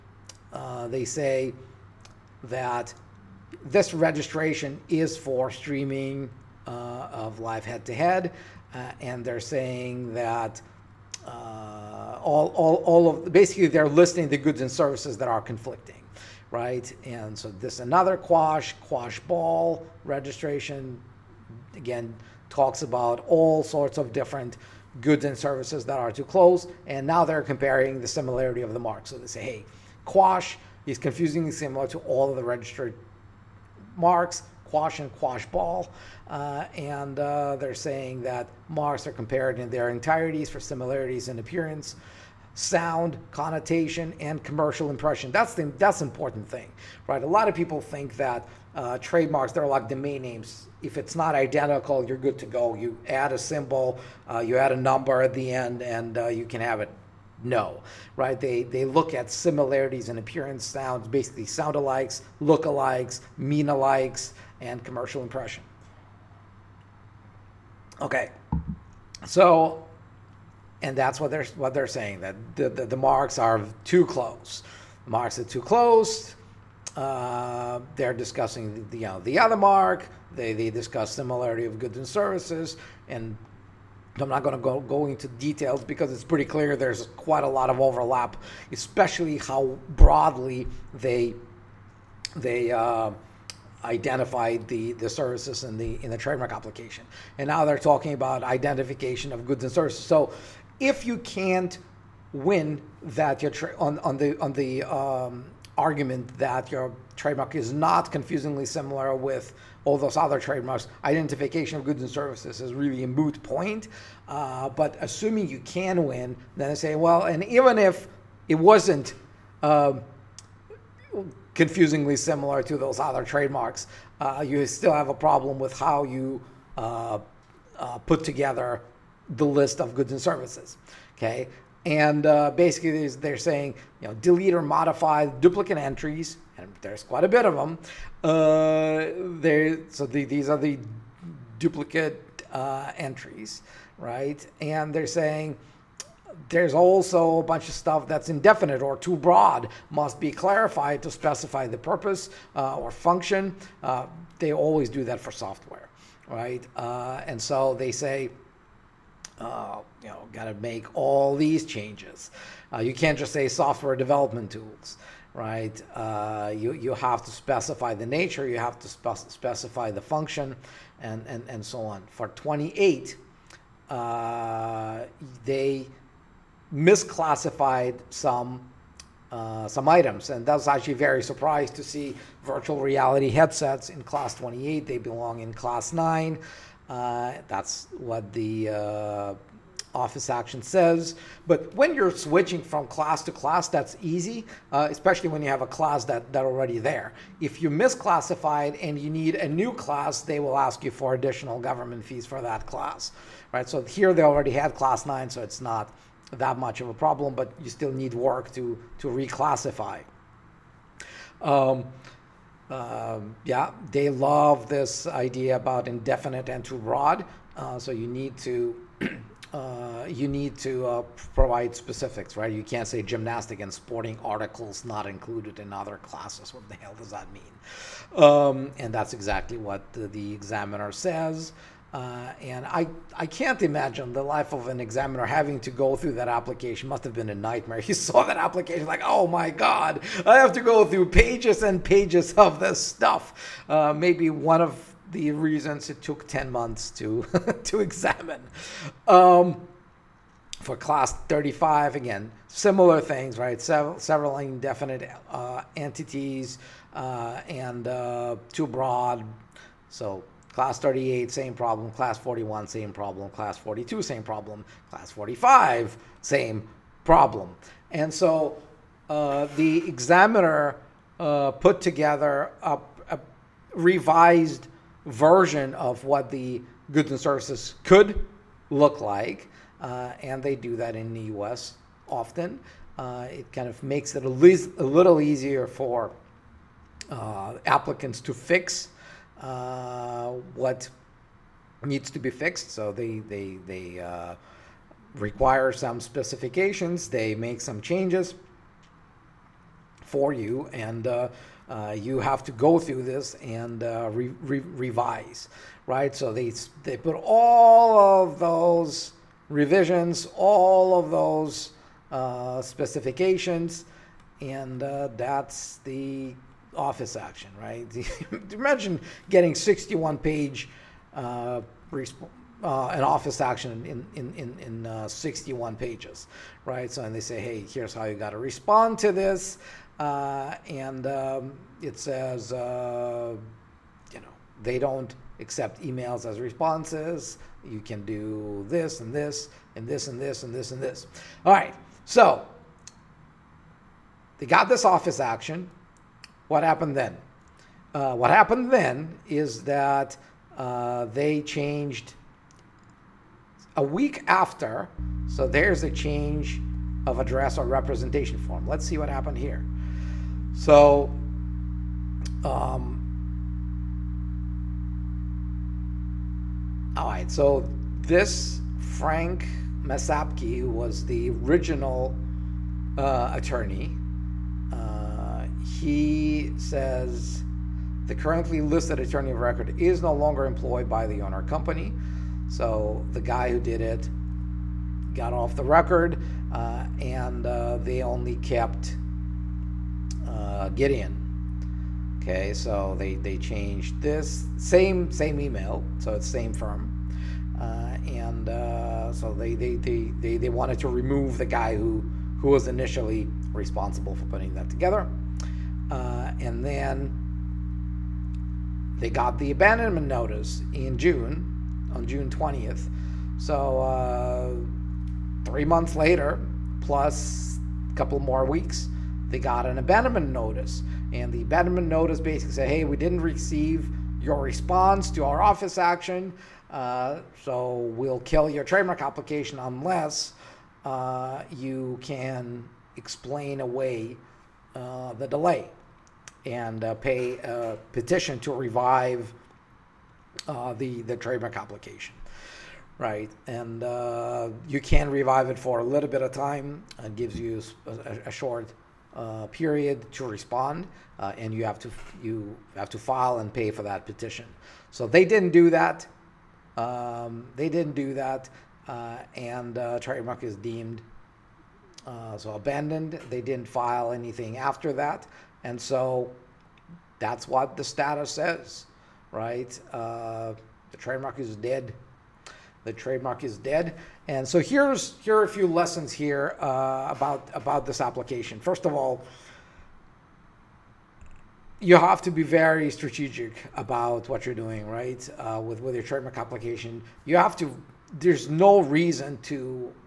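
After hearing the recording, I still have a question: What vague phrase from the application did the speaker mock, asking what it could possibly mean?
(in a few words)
gymnastic and sporting articles.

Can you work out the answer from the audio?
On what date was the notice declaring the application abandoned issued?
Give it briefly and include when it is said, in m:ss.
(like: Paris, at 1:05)
June 20, at 6:52.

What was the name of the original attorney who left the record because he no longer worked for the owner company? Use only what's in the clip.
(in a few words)
Frank Masapki.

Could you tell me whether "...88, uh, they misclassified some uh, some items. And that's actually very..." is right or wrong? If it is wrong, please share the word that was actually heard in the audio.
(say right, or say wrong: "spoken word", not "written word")
wrong: "28", not "88".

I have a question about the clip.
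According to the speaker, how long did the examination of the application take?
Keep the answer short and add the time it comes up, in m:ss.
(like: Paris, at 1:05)
10 months, at 4:06.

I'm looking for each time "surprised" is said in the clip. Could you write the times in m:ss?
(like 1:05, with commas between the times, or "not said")
3:01.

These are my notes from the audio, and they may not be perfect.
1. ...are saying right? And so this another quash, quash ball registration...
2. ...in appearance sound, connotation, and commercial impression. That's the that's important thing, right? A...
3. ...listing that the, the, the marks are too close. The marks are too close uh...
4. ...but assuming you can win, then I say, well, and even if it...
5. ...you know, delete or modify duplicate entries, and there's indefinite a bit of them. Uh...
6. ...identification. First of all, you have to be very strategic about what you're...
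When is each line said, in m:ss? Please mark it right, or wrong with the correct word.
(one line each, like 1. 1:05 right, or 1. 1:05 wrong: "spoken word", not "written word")
1. 0:15 wrong: "conflicting", not "saying"
2. 0:41 right
3. 1:11 wrong: "saying", not "listing"
4. 1:54 right
5. 2:14 wrong: "quite", not "indefinite"
6. 7:57 wrong: "application", not "identification".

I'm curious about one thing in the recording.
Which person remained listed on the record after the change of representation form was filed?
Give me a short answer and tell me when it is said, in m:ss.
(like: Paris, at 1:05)
Gideon, at 6:30.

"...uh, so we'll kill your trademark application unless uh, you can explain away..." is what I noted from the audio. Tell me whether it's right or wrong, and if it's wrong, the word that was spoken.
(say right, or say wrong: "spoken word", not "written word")
right.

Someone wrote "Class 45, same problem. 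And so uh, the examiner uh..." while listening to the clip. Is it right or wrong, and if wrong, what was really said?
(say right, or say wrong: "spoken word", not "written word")
right.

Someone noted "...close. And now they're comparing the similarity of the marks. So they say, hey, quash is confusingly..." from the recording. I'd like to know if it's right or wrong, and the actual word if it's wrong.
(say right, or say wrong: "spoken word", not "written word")
right.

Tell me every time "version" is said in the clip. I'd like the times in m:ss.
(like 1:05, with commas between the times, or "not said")
4:35.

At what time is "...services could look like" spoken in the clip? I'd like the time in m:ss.
4:37.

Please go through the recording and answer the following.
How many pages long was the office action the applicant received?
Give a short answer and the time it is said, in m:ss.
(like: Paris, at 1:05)
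61, at 5:19.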